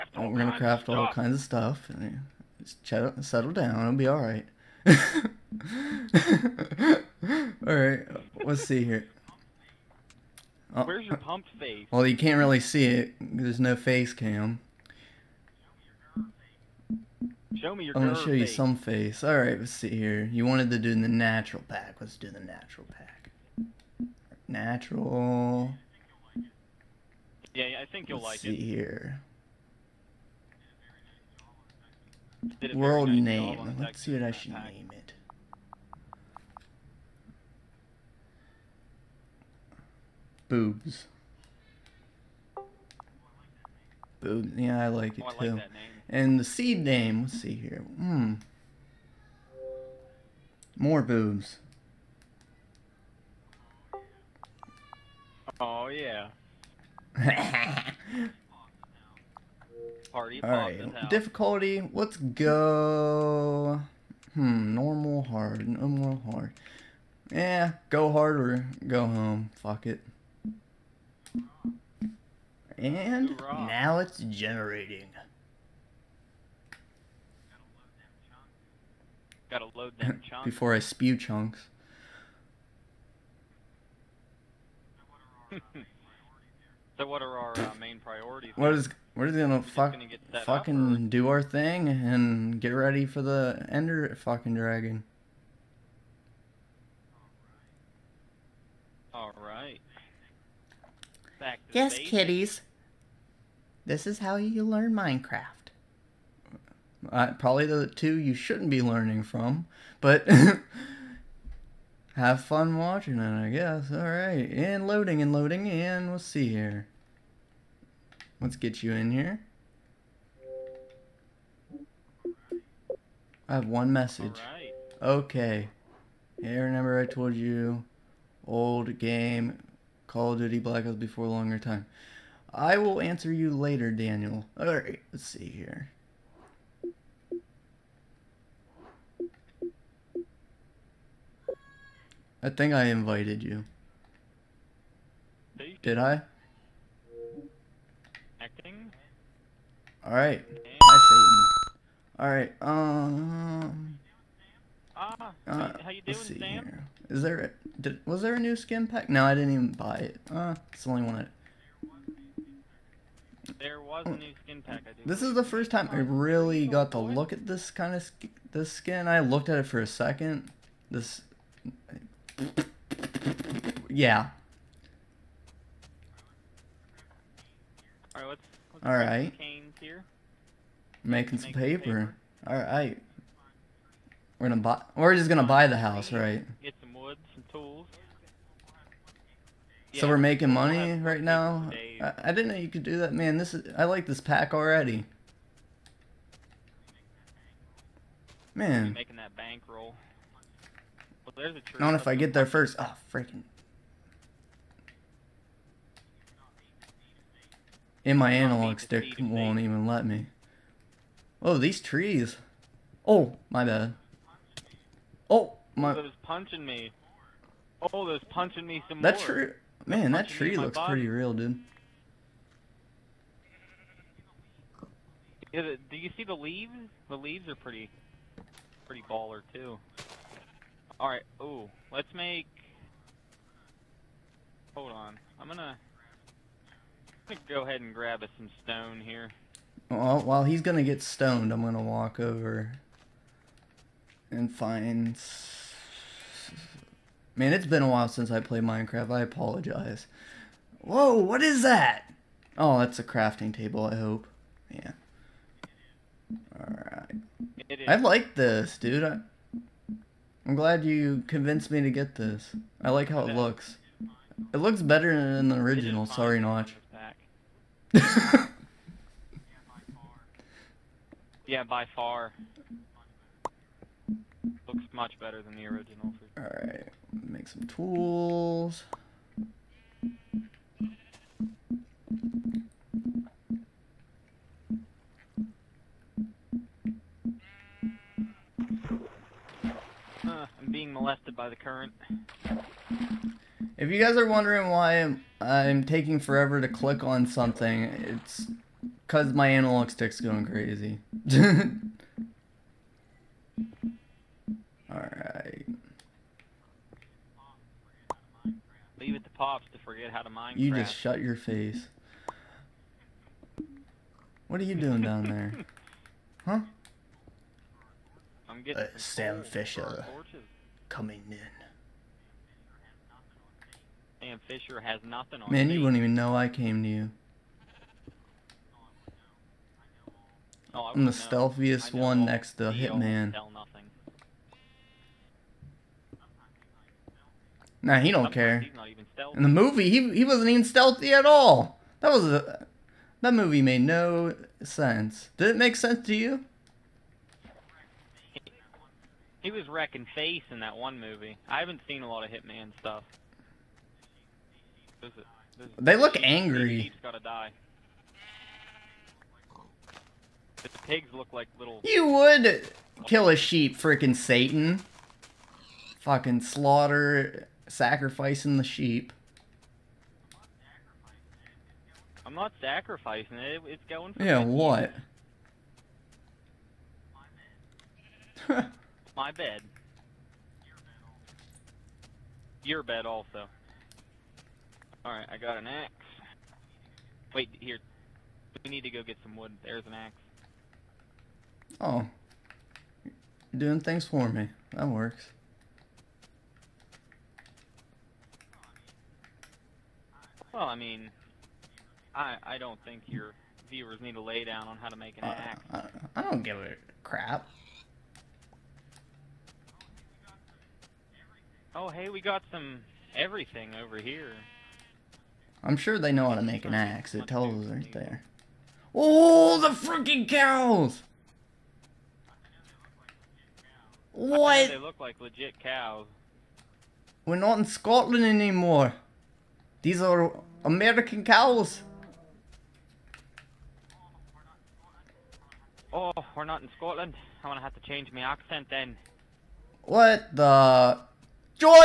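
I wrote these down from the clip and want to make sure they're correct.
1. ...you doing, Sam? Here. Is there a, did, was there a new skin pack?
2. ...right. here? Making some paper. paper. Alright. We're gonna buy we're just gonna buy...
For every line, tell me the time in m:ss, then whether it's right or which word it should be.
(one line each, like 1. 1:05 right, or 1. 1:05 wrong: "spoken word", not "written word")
1. 2:35 right
2. 2:58 right.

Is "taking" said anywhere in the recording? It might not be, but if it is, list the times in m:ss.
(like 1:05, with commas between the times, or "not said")
4:55.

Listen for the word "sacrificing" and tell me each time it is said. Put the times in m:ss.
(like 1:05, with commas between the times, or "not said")
6:07, 6:12.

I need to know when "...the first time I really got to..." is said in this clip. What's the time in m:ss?
2:45.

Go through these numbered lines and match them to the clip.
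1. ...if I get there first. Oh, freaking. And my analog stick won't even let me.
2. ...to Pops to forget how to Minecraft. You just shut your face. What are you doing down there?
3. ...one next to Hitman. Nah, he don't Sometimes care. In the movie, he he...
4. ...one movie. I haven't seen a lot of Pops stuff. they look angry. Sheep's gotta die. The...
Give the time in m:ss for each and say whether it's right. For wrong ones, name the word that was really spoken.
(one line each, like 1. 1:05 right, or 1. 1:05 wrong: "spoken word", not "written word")
1. 3:21 right
2. 5:09 right
3. 5:31 right
4. 5:50 wrong: "Hitman", not "Pops".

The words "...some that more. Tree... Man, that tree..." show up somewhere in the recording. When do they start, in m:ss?
3:38.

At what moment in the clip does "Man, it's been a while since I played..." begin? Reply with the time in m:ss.
4:07.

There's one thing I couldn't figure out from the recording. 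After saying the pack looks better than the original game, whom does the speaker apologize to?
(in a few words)
Notch.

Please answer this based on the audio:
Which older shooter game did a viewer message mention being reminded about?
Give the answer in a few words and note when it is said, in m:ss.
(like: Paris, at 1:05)
Call of Duty Black Ops, at 2:10.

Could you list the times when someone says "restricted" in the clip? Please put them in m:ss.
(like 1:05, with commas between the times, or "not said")
not said.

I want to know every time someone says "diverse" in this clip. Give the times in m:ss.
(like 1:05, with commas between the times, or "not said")
not said.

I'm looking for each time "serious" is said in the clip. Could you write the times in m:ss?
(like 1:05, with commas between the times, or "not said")
not said.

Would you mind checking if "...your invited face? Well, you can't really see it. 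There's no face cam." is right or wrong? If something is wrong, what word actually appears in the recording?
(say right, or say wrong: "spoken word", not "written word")
wrong: "pumped", not "invited".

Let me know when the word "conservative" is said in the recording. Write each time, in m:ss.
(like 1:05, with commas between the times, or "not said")
not said.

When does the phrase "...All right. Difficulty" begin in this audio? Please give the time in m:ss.
1:00.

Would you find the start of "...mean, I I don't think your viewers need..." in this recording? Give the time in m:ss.
6:40.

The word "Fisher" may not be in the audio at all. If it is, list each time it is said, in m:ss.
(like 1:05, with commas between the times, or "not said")
5:19, 5:24.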